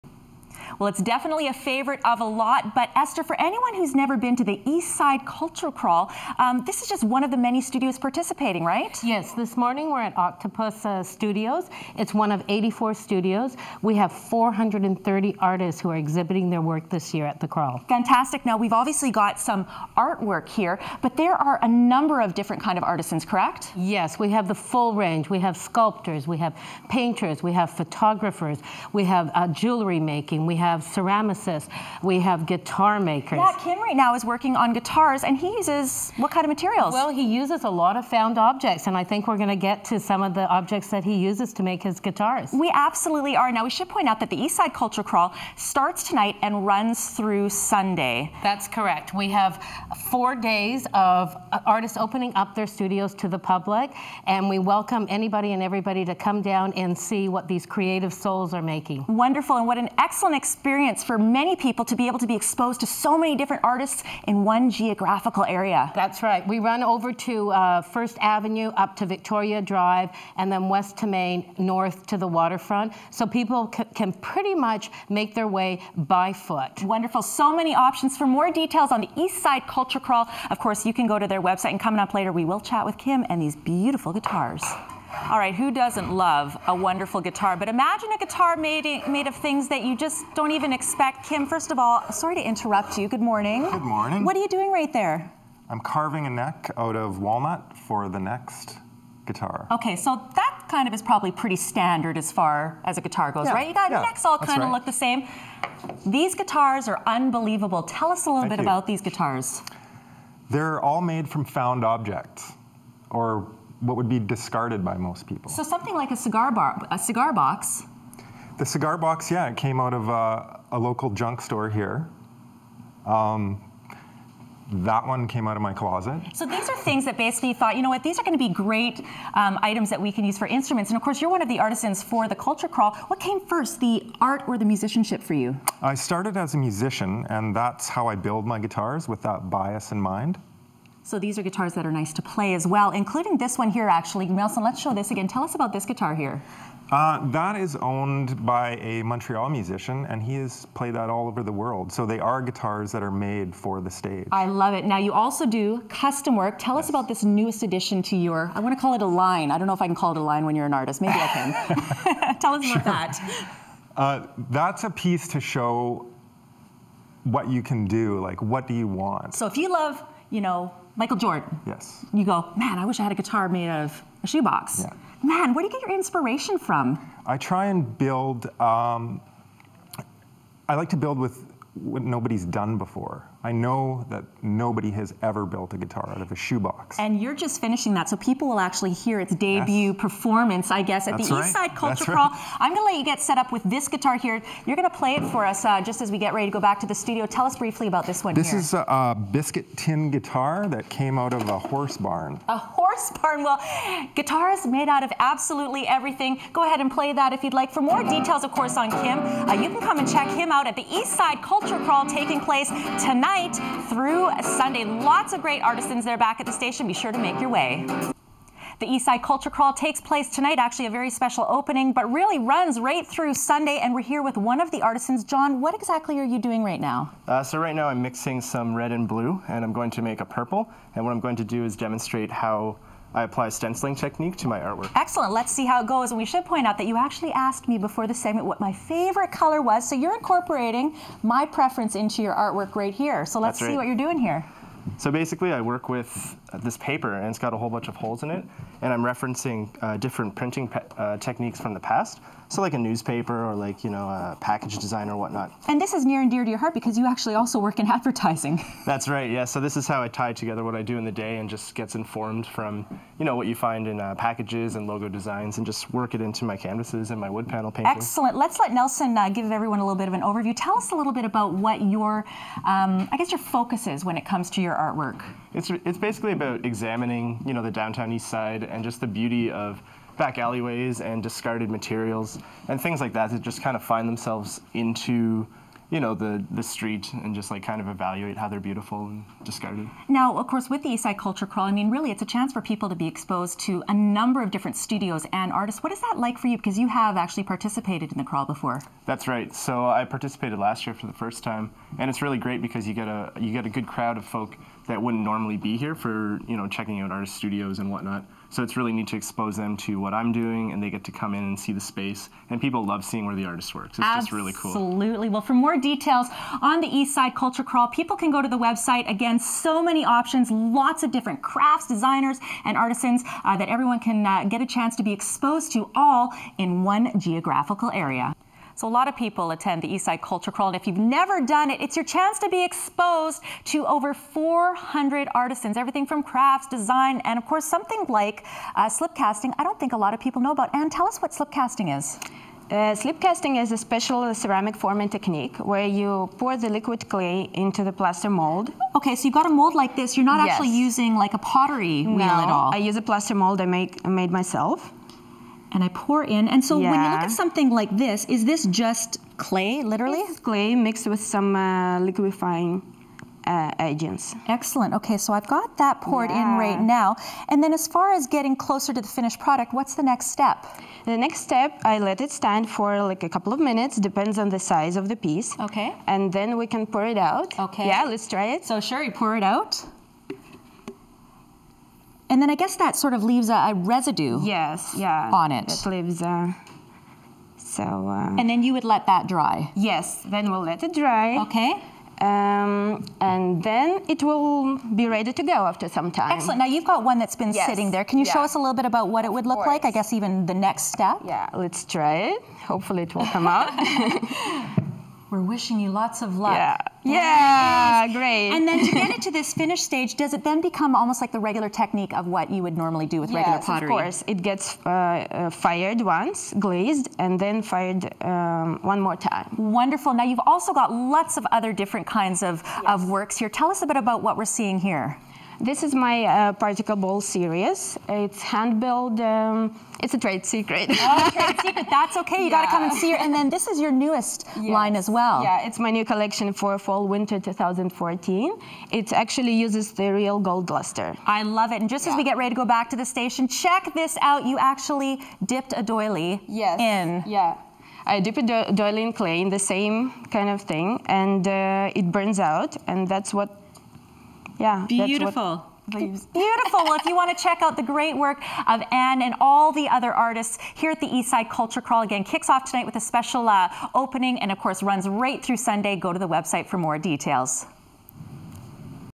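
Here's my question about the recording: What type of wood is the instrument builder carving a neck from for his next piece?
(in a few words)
Walnut.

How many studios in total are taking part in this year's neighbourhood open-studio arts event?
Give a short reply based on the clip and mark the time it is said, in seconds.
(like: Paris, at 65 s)
84, at 12 s.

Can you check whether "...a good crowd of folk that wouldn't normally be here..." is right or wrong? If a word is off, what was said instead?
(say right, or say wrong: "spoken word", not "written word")
right.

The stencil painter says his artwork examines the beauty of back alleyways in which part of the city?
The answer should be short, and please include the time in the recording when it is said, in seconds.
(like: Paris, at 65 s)
The downtown east side, at 277 s.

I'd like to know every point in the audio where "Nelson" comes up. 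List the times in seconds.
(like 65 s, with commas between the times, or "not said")
144 s, 268 s.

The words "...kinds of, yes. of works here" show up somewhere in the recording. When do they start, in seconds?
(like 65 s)
422 s.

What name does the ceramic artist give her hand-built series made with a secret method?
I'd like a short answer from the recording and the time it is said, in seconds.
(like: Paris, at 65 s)
Particle ball series, at 426 s.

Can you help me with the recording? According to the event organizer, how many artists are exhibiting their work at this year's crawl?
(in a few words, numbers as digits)
430.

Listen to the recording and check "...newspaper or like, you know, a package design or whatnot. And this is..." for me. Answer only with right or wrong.
right.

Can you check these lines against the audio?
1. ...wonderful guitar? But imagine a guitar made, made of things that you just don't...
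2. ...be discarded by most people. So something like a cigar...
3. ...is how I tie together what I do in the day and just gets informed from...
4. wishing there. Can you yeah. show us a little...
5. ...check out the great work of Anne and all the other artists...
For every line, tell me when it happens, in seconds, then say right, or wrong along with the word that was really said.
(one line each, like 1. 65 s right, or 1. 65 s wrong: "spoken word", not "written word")
1. 86 s right
2. 114 s right
3. 259 s right
4. 397 s wrong: "sitting", not "wishing"
5. 457 s right.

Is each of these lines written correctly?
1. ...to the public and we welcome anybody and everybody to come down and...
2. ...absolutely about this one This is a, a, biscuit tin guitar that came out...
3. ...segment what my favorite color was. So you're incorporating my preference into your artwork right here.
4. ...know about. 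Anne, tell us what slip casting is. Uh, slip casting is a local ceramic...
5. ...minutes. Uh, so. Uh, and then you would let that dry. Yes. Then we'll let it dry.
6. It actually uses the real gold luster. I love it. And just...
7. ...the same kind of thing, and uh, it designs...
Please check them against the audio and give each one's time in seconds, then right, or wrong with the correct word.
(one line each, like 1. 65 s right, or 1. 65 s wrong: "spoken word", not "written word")
1. 53 s right
2. 197 s wrong: "briefly", not "absolutely"
3. 238 s right
4. 340 s wrong: "special", not "local"
5. 385 s wrong: "leaves", not "minutes"
6. 438 s right
7. 449 s wrong: "burns", not "designs".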